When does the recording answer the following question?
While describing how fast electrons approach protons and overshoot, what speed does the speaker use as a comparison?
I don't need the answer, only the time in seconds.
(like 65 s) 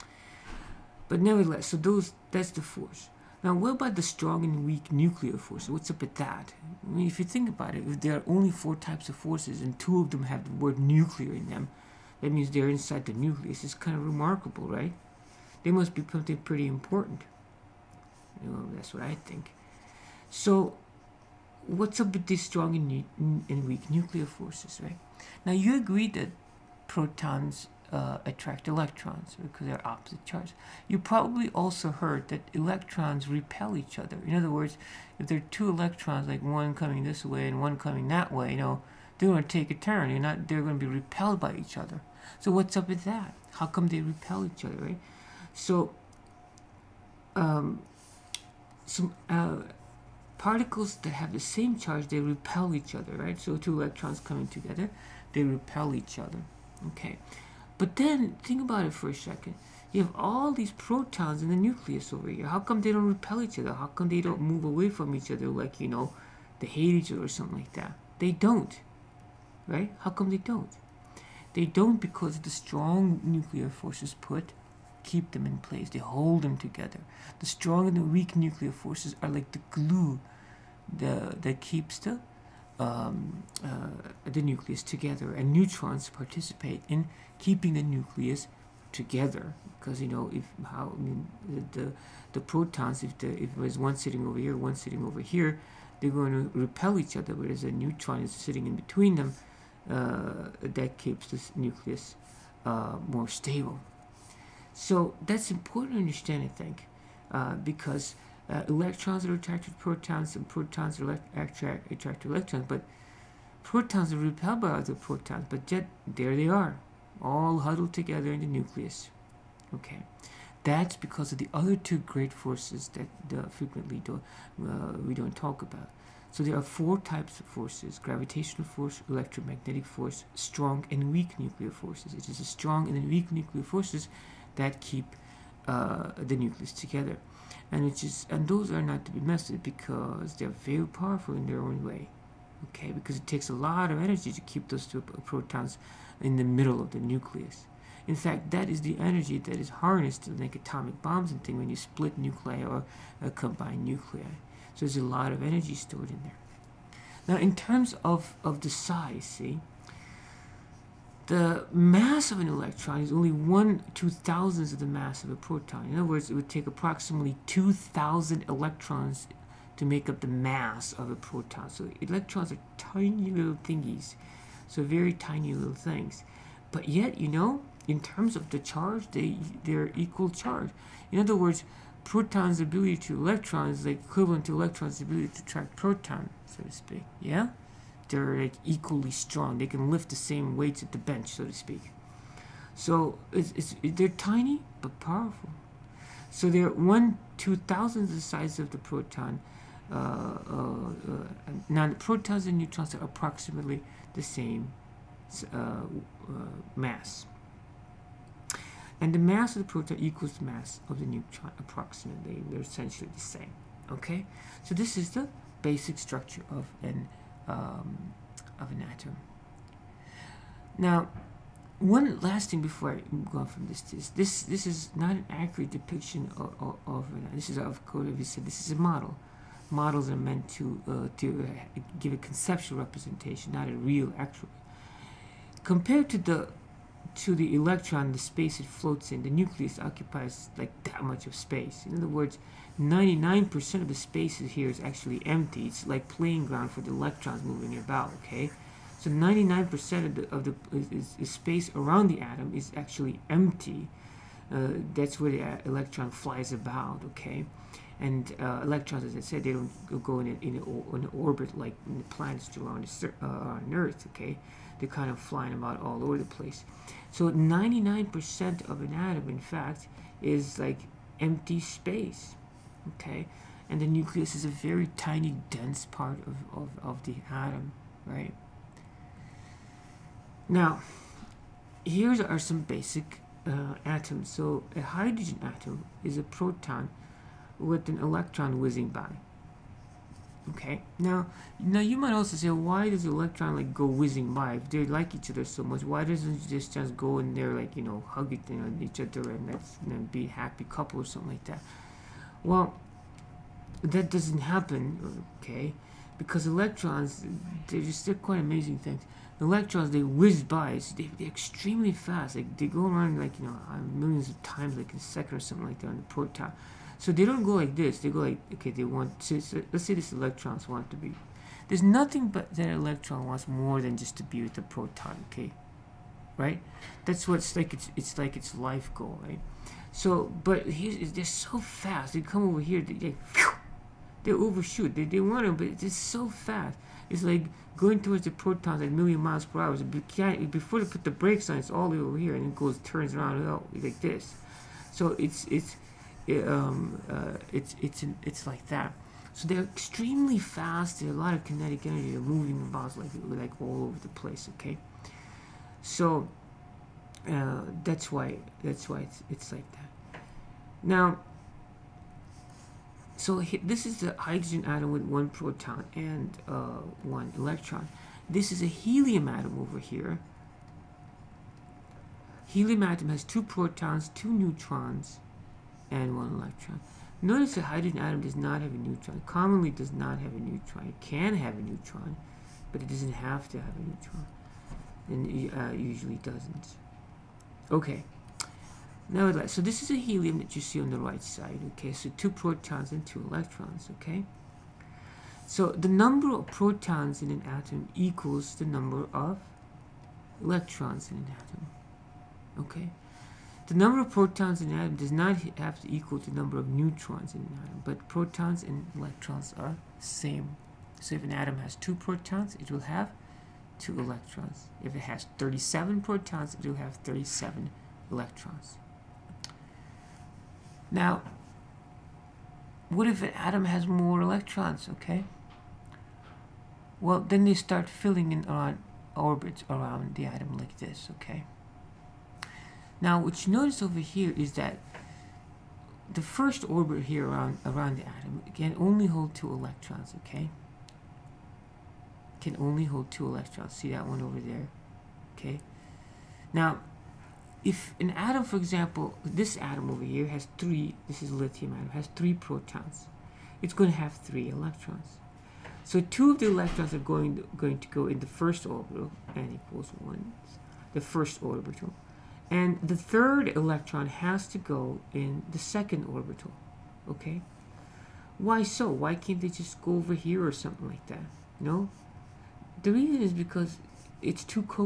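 338 s.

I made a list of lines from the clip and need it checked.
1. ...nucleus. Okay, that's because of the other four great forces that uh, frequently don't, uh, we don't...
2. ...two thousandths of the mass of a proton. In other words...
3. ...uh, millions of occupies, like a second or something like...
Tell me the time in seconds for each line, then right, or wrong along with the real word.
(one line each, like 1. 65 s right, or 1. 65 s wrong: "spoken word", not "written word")
1. 118 s wrong: "two", not "four"
2. 163 s right
3. 313 s wrong: "times", not "occupies".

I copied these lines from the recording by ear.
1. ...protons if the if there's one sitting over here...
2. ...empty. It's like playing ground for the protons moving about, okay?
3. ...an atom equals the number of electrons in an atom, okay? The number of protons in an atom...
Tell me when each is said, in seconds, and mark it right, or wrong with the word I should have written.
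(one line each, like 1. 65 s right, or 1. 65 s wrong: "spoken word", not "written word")
1. 92 s right
2. 245 s wrong: "electrons", not "protons"
3. 397 s right.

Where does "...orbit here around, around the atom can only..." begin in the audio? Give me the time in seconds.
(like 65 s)
436 s.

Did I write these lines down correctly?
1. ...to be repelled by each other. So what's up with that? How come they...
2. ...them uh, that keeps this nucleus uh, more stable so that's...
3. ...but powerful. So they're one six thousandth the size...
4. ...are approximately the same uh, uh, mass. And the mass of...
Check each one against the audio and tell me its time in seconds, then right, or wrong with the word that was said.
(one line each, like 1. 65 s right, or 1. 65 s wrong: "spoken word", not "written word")
1. 40 s right
2. 99 s right
3. 194 s wrong: "two", not "six"
4. 202 s right.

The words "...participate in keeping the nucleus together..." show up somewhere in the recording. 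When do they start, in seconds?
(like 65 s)
86 s.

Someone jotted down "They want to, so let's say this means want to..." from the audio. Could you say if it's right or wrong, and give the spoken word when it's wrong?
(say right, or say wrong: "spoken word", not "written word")
wrong: "electrons", not "means".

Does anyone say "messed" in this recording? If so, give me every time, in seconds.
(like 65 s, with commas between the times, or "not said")
139 s.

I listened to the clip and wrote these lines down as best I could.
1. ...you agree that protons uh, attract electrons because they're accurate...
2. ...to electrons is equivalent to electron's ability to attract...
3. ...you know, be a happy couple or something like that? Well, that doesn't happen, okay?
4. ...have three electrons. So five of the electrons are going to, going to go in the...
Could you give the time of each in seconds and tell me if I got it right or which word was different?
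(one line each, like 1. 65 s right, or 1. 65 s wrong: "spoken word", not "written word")
1. 25 s wrong: "opposite", not "accurate"
2. 182 s right
3. 299 s right
4. 453 s wrong: "two", not "five".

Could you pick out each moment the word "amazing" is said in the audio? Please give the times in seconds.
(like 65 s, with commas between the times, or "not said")
308 s.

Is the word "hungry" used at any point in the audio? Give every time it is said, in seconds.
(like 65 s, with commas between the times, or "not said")
not said.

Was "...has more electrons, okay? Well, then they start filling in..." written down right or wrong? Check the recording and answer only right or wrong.
right.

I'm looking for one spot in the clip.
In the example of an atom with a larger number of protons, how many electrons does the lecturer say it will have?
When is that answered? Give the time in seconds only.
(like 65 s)
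417 s.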